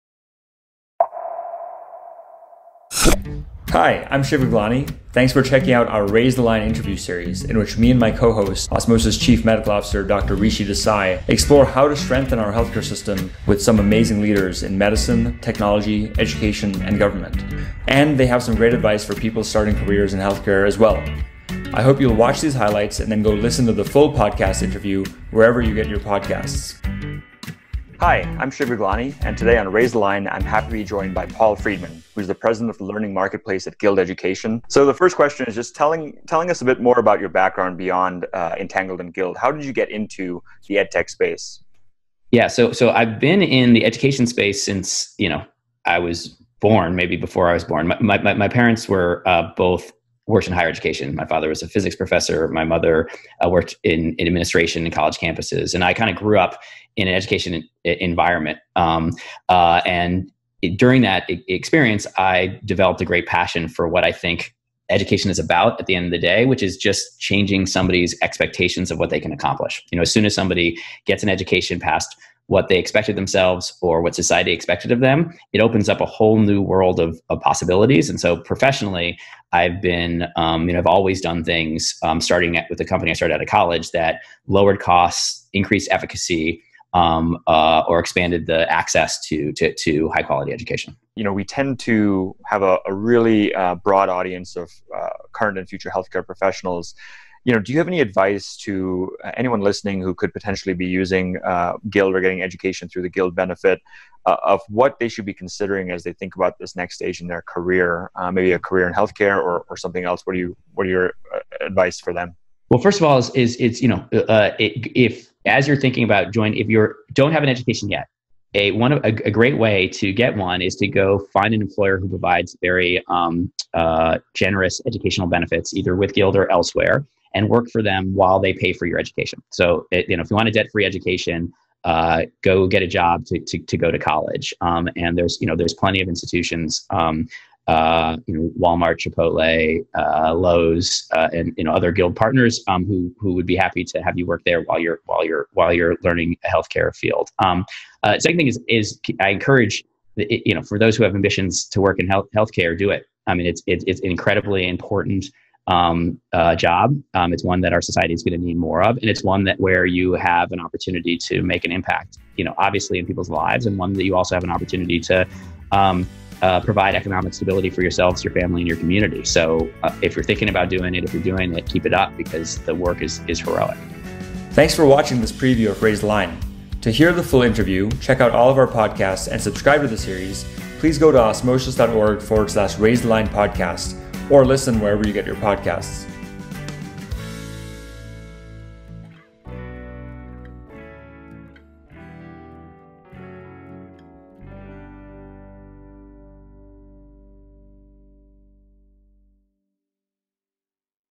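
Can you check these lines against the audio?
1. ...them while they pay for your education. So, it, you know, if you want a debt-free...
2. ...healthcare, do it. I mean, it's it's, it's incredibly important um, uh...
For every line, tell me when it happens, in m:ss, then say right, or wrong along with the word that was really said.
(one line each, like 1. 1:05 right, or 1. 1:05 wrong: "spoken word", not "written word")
1. 2:07 right
2. 2:32 right.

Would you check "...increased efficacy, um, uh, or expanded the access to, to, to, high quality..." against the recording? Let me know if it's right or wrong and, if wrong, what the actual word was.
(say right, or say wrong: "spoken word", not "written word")
right.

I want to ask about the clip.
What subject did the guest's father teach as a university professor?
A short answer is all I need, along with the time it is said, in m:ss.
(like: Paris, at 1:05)
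physics, at 0:51.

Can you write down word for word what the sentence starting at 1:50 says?
What do you what are your uh, advice for them?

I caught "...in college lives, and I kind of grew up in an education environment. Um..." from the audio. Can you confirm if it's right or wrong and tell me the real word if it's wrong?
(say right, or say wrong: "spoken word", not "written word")
wrong: "campuses", not "lives".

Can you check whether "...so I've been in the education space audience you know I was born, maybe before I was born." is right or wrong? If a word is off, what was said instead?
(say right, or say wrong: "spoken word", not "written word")
wrong: "since", not "audience".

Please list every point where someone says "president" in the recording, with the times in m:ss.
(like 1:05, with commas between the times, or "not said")
0:32.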